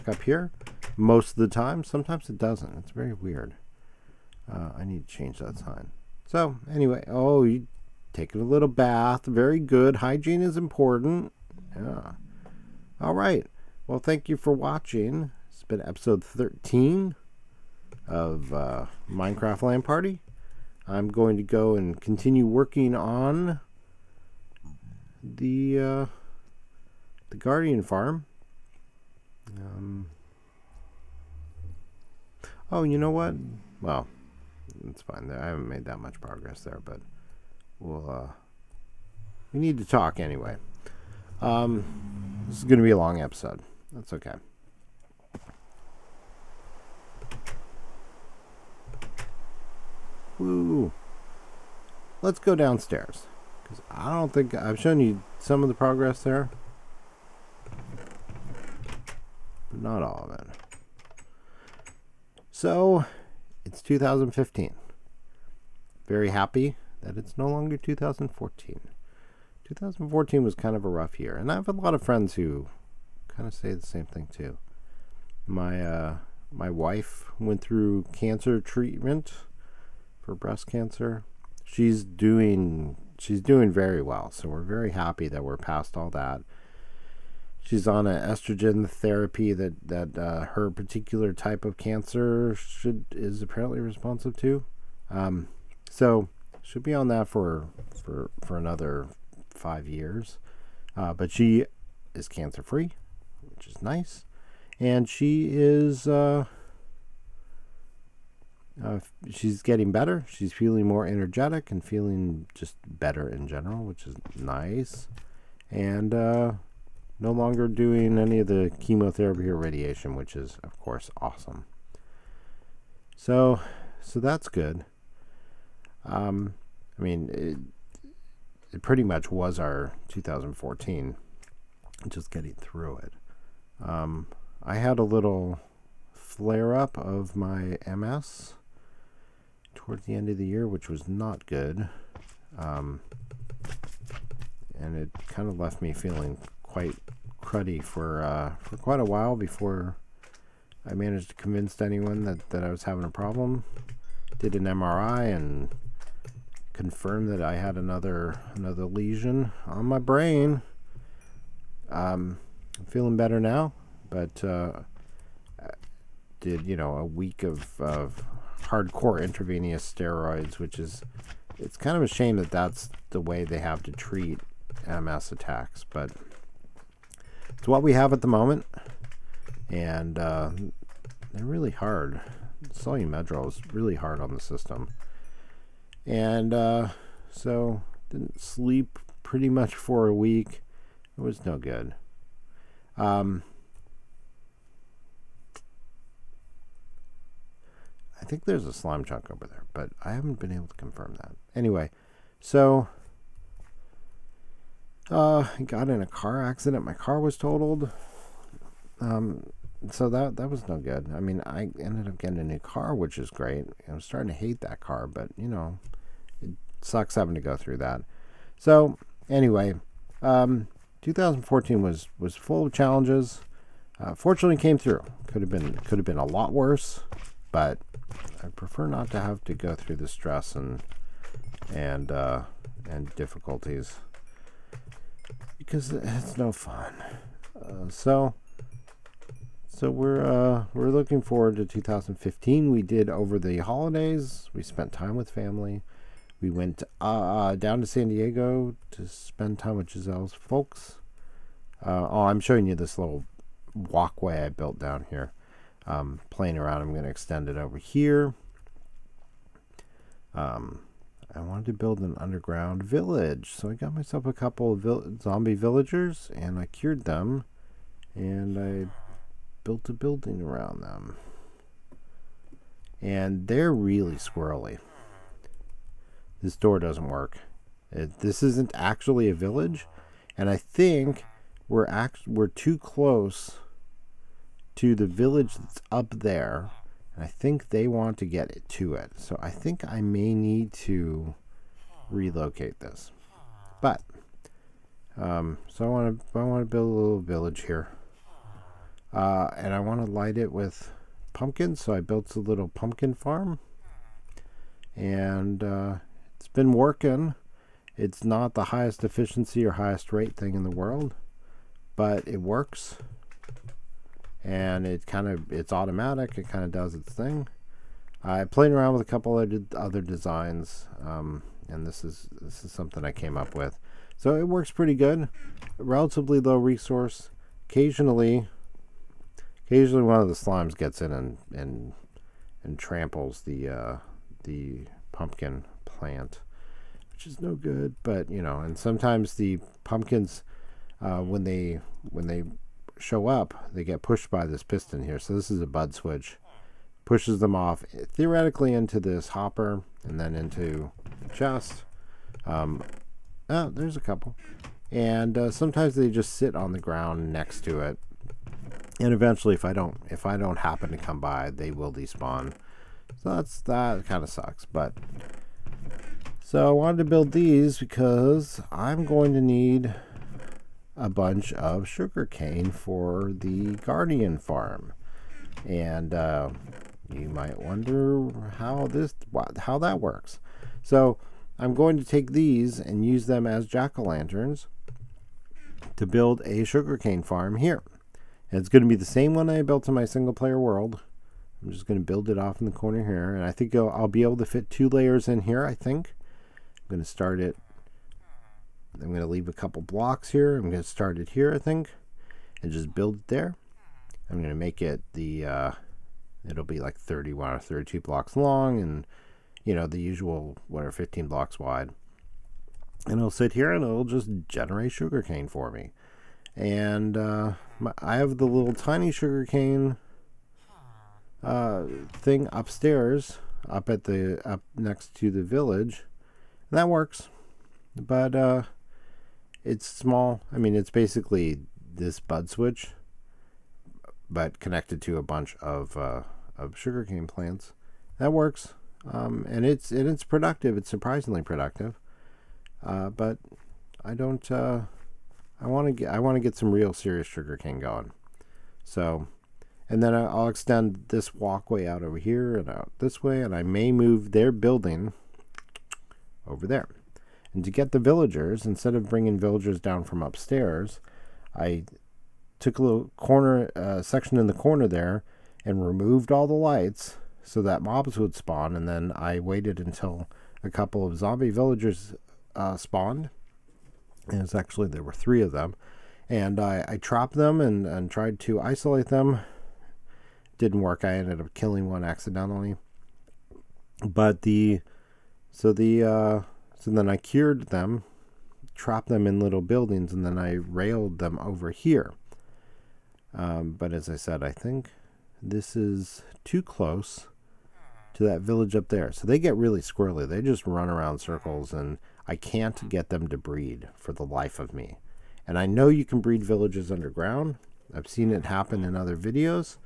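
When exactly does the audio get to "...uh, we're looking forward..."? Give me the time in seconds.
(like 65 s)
240 s.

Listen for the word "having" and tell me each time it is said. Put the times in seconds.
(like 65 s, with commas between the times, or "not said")
152 s, 217 s.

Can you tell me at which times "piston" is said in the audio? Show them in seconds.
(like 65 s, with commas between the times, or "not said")
344 s.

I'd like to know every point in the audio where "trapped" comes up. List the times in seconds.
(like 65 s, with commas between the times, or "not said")
476 s, 488 s.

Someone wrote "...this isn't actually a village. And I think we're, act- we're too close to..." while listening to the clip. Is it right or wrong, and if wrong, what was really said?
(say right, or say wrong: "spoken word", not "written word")
right.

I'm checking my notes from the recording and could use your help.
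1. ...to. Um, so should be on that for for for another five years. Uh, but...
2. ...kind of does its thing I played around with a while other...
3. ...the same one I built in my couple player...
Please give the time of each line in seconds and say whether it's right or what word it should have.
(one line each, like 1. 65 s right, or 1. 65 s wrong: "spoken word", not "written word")
1. 94 s right
2. 316 s wrong: "couple", not "while"
3. 388 s wrong: "single", not "couple".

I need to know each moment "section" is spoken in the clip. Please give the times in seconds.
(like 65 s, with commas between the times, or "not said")
464 s.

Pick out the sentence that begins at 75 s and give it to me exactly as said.
My uh, my wife went through cancer treatment for breast cancer.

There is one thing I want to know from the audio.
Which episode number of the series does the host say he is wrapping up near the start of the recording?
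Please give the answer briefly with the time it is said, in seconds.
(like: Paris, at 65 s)
13, at 16 s.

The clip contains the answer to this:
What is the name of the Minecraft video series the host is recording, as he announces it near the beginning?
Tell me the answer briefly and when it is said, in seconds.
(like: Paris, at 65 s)
Minecraft LAN Party, at 19 s.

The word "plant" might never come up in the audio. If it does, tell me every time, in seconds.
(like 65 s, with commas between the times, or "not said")
335 s, 437 s.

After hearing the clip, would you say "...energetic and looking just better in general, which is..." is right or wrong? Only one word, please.
wrong.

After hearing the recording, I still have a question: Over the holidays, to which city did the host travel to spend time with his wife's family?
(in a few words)
San Diego.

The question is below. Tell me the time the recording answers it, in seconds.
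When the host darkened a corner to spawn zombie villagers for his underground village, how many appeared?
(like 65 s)
475 s.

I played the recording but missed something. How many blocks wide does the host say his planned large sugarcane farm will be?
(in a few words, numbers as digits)
15.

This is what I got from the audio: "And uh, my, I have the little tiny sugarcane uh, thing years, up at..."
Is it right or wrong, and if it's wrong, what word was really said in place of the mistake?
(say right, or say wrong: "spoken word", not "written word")
wrong: "upstairs", not "years".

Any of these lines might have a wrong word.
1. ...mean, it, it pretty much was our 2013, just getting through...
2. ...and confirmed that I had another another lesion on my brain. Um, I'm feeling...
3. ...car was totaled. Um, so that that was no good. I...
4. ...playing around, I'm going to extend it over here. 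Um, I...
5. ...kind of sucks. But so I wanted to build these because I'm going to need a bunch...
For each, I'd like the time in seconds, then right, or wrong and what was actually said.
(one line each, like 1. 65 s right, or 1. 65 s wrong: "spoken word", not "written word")
1. 127 s wrong: "2014", not "2013"
2. 155 s right
3. 206 s right
4. 256 s right
5. 364 s right.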